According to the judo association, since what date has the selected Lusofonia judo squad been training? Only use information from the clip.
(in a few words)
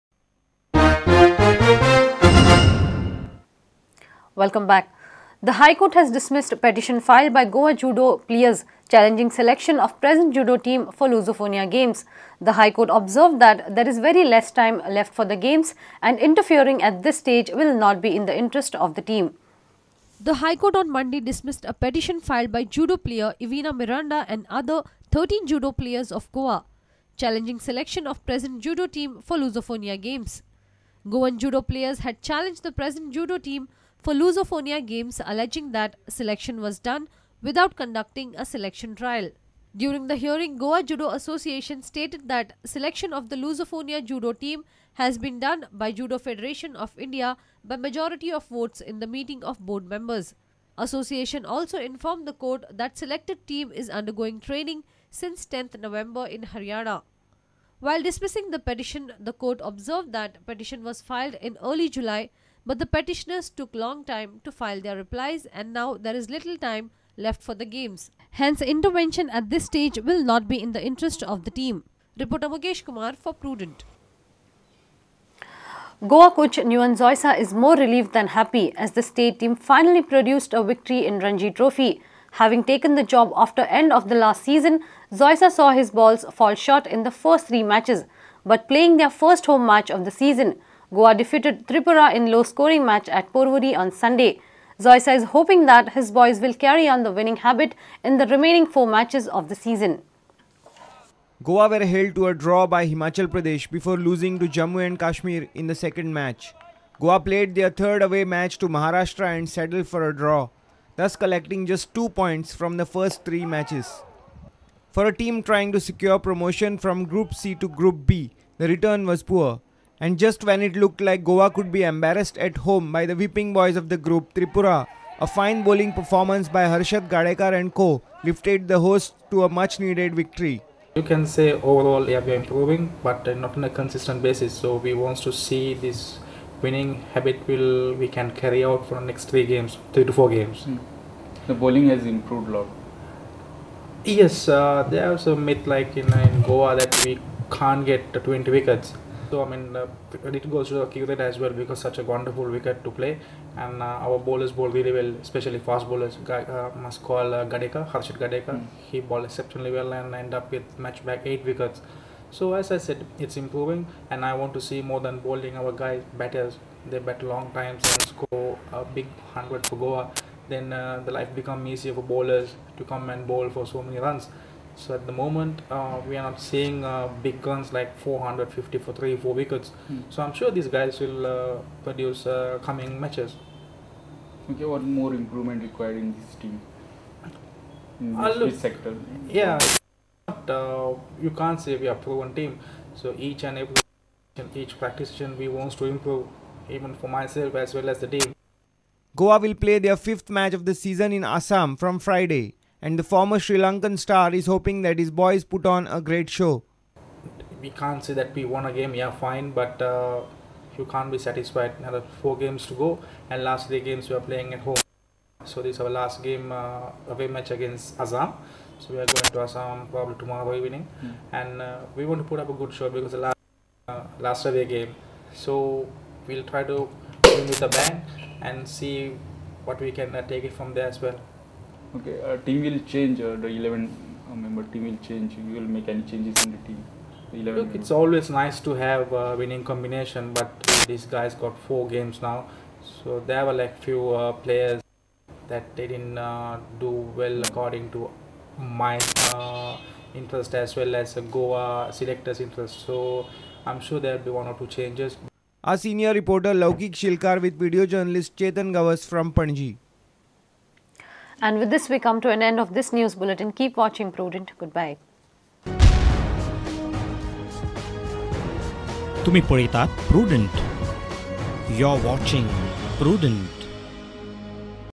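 10 November.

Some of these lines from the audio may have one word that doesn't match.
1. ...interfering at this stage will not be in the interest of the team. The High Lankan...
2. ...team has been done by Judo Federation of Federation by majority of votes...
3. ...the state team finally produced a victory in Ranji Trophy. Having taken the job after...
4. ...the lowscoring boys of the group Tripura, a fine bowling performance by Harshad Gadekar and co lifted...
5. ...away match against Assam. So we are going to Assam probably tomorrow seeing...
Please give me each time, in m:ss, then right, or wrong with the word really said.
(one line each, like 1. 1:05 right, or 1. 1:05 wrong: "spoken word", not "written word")
1. 0:16 wrong: "Court", not "Lankan"
2. 0:44 wrong: "India", not "Federation"
3. 1:18 right
4. 2:03 wrong: "whipping", not "lowscoring"
5. 3:37 wrong: "evening", not "seeing".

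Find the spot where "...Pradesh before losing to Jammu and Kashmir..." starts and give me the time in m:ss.
1:43.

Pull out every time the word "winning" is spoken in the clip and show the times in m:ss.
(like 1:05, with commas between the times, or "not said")
1:37, 2:16, 3:59.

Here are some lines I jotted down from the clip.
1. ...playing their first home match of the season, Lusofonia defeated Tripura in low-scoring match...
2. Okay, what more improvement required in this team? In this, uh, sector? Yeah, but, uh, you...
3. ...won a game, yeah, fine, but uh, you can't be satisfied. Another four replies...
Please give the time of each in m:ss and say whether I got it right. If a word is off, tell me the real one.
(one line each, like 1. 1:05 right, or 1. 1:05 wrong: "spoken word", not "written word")
1. 1:28 wrong: "Goa", not "Lusofonia"
2. 3:04 right
3. 3:28 wrong: "games", not "replies".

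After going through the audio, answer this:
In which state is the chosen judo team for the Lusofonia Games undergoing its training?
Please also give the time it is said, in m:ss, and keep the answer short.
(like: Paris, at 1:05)
Haryana, at 0:56.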